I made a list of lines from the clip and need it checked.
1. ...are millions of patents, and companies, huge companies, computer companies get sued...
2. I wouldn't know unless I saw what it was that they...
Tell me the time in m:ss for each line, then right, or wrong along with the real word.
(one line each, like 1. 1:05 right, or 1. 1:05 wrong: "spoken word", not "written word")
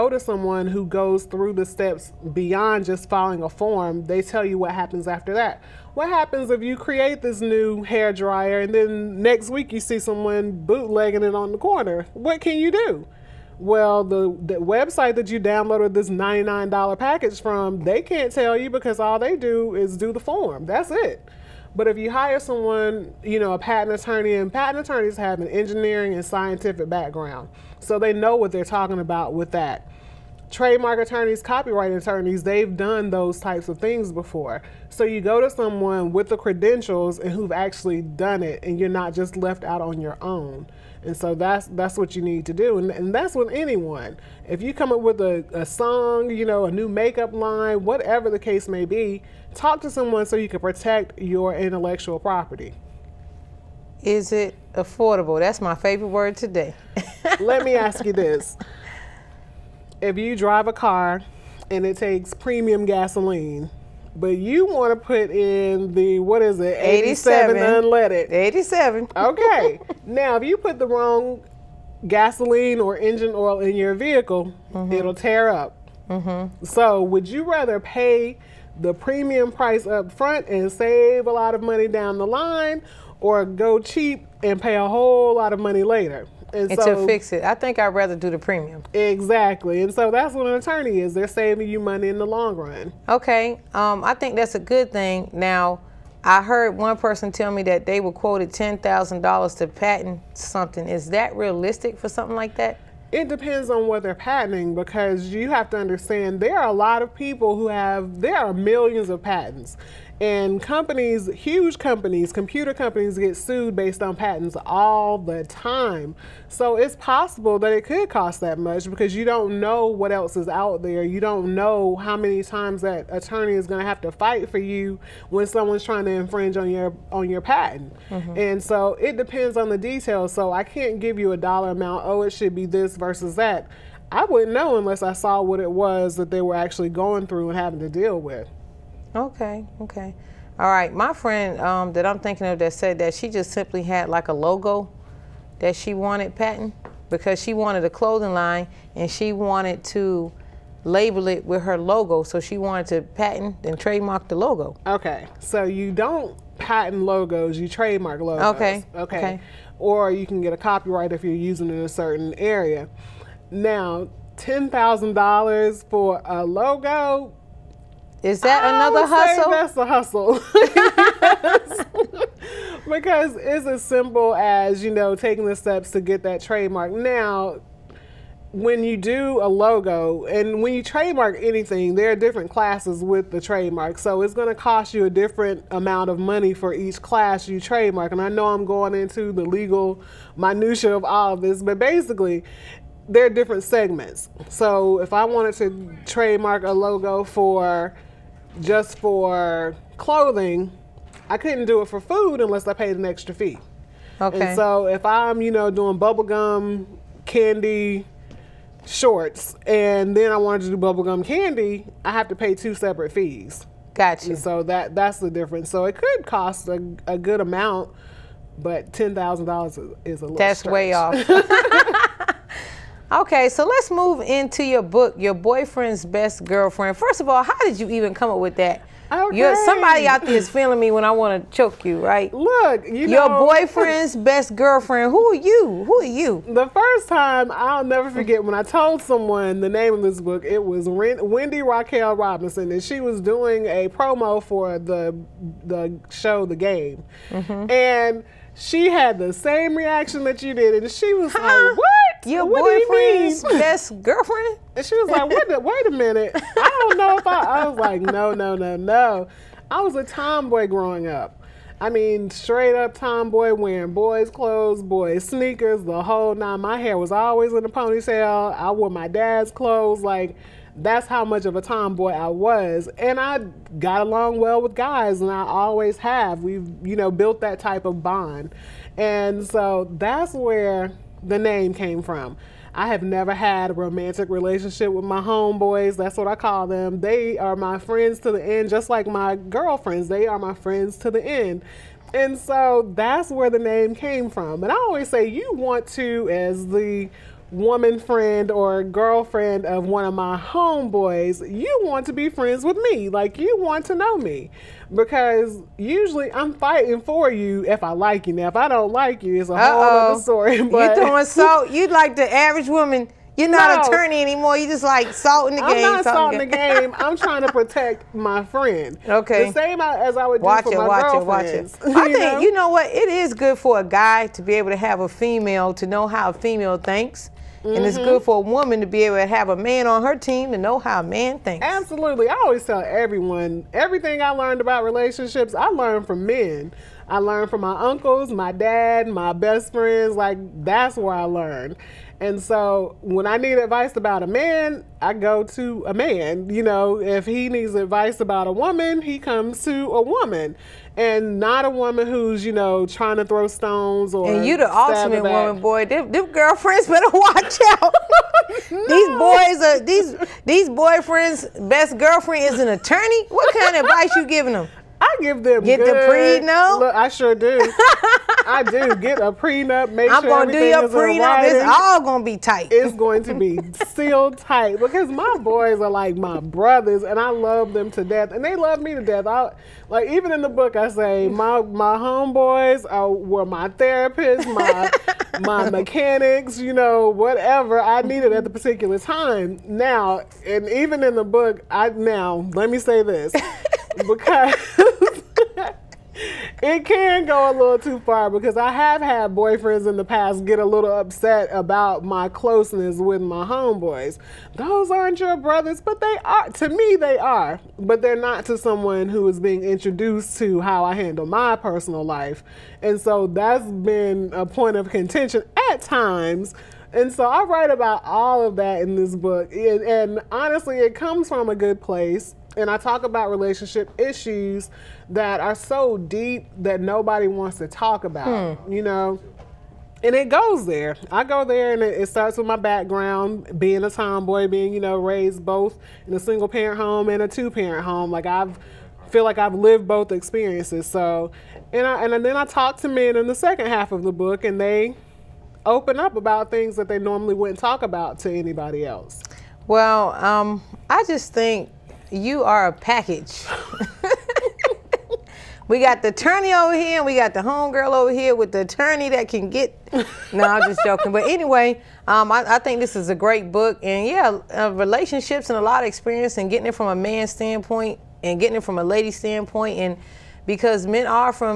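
1. 1:48 right
2. 2:14 right.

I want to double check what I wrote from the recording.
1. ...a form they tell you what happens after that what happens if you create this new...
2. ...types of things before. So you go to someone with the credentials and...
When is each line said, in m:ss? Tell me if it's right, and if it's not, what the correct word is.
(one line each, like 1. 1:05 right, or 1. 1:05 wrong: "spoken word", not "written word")
1. 0:03 right
2. 0:33 right.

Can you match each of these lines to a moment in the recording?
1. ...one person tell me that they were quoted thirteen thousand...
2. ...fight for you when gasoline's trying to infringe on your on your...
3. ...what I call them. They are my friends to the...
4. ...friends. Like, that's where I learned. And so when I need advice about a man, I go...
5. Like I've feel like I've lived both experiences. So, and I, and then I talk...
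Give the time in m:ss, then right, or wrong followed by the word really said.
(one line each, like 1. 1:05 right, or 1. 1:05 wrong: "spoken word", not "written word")
1. 1:36 wrong: "ten", not "thirteen"
2. 2:04 wrong: "someone", not "gasoline"
3. 4:46 right
4. 5:39 right
5. 7:18 right.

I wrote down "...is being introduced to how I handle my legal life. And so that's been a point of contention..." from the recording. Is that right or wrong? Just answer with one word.
wrong.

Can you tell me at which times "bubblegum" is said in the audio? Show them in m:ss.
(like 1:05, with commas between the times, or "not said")
3:25, 3:30.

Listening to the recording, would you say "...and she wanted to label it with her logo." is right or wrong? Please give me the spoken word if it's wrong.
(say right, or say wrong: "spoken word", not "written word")
right.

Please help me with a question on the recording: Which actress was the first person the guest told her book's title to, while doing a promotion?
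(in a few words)
Wendy Raquel Robinson.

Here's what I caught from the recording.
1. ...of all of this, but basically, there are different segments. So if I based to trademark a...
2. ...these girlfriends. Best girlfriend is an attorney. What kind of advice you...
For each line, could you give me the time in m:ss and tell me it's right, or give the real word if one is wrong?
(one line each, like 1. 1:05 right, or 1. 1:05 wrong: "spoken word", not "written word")
1. 3:10 wrong: "wanted", not "based"
2. 6:00 wrong: "boyfriends", not "girlfriends".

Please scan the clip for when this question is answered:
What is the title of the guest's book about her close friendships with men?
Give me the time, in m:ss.
3:45.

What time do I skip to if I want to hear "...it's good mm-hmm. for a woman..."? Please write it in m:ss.
5:27.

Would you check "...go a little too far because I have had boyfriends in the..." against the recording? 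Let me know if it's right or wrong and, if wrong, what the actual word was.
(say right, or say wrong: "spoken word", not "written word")
right.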